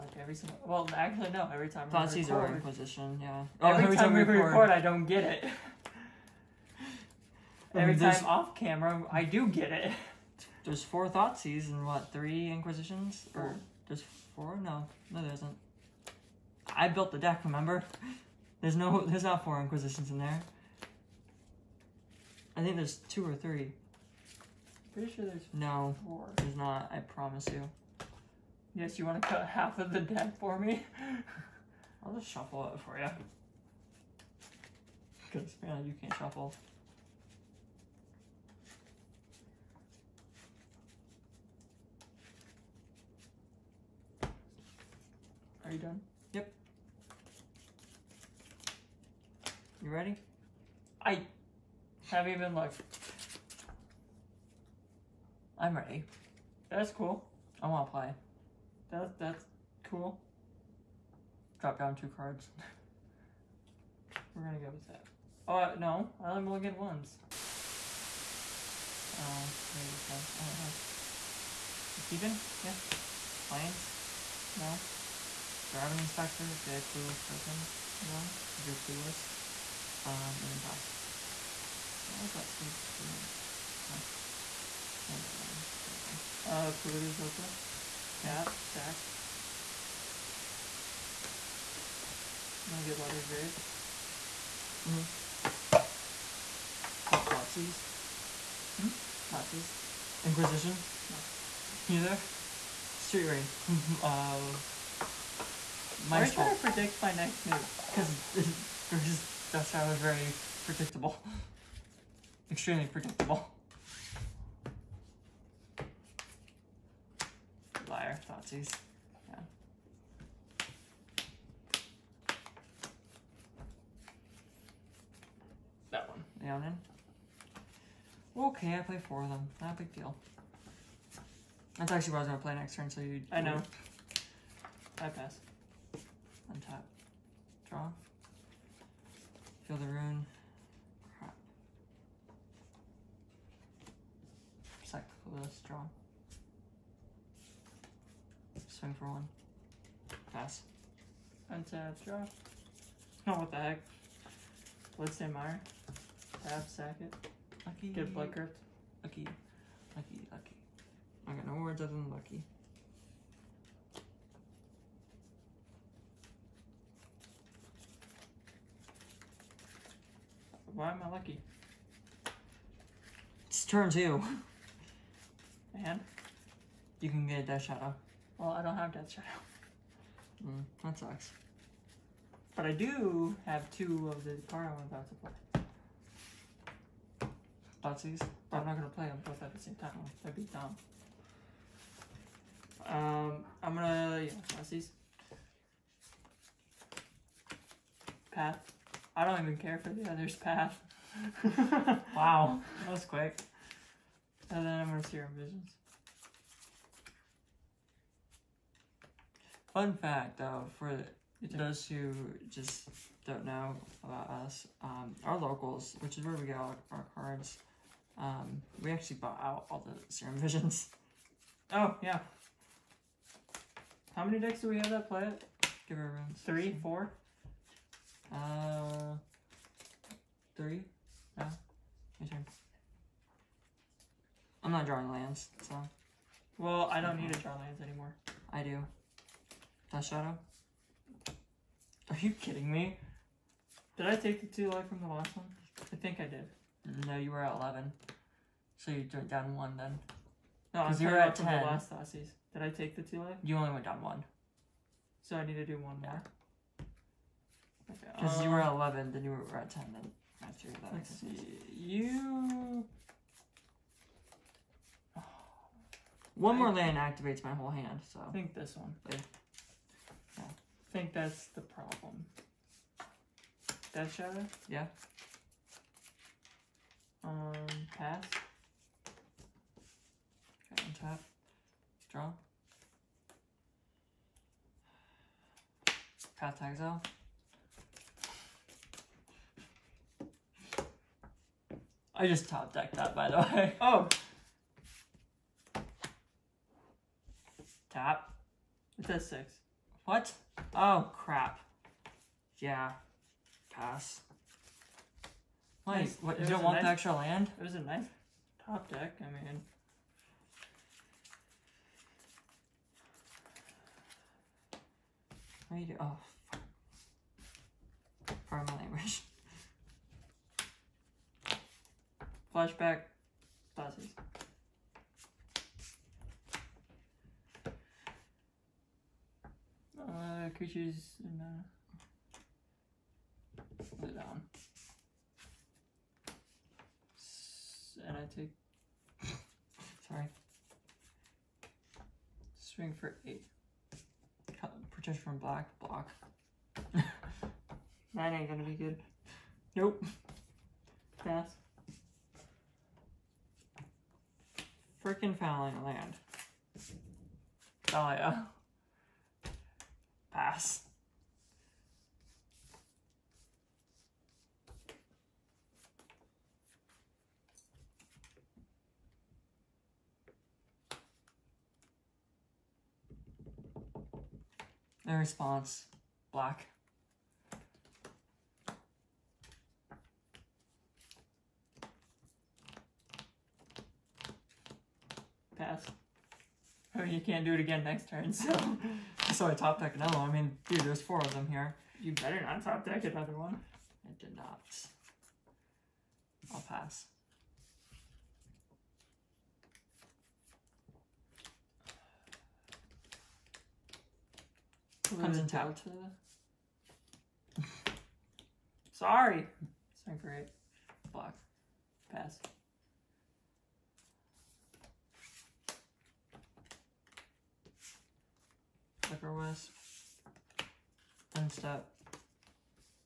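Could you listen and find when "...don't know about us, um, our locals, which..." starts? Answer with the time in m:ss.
3:33.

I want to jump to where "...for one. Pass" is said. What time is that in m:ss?
2:28.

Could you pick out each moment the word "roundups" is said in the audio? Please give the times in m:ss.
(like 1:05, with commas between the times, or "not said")
not said.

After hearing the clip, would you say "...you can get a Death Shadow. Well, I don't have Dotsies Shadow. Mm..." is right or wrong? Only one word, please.
wrong.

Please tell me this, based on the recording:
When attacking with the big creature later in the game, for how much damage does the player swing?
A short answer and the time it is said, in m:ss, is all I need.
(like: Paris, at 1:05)
8, at 5:43.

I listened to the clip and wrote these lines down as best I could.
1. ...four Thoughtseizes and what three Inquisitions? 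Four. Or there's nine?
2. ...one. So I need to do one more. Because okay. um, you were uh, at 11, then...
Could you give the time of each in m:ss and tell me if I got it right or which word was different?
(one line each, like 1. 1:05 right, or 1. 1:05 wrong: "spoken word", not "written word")
1. 0:10 wrong: "four", not "nine"
2. 4:14 right.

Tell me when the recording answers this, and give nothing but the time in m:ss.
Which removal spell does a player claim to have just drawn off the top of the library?
4:46.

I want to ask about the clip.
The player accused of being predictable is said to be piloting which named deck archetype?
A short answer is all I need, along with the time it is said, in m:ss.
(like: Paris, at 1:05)
Grixis Death Shadow, at 1:48.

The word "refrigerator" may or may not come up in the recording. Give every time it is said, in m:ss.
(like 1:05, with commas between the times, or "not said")
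not said.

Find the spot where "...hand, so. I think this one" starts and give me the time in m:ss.
4:27.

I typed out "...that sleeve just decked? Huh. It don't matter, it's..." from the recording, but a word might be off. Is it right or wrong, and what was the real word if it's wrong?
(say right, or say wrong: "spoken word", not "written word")
wrong: "ruined", not "decked".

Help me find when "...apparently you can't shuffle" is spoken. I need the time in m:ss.
0:35.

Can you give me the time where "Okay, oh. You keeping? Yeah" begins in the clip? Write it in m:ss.
1:10.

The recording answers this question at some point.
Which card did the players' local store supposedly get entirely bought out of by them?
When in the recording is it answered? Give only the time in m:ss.
3:40.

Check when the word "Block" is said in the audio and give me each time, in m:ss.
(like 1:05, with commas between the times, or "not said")
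5:45, 6:51.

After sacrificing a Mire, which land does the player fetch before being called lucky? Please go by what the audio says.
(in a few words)
Blood Crypt.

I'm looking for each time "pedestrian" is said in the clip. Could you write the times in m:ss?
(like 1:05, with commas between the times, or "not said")
not said.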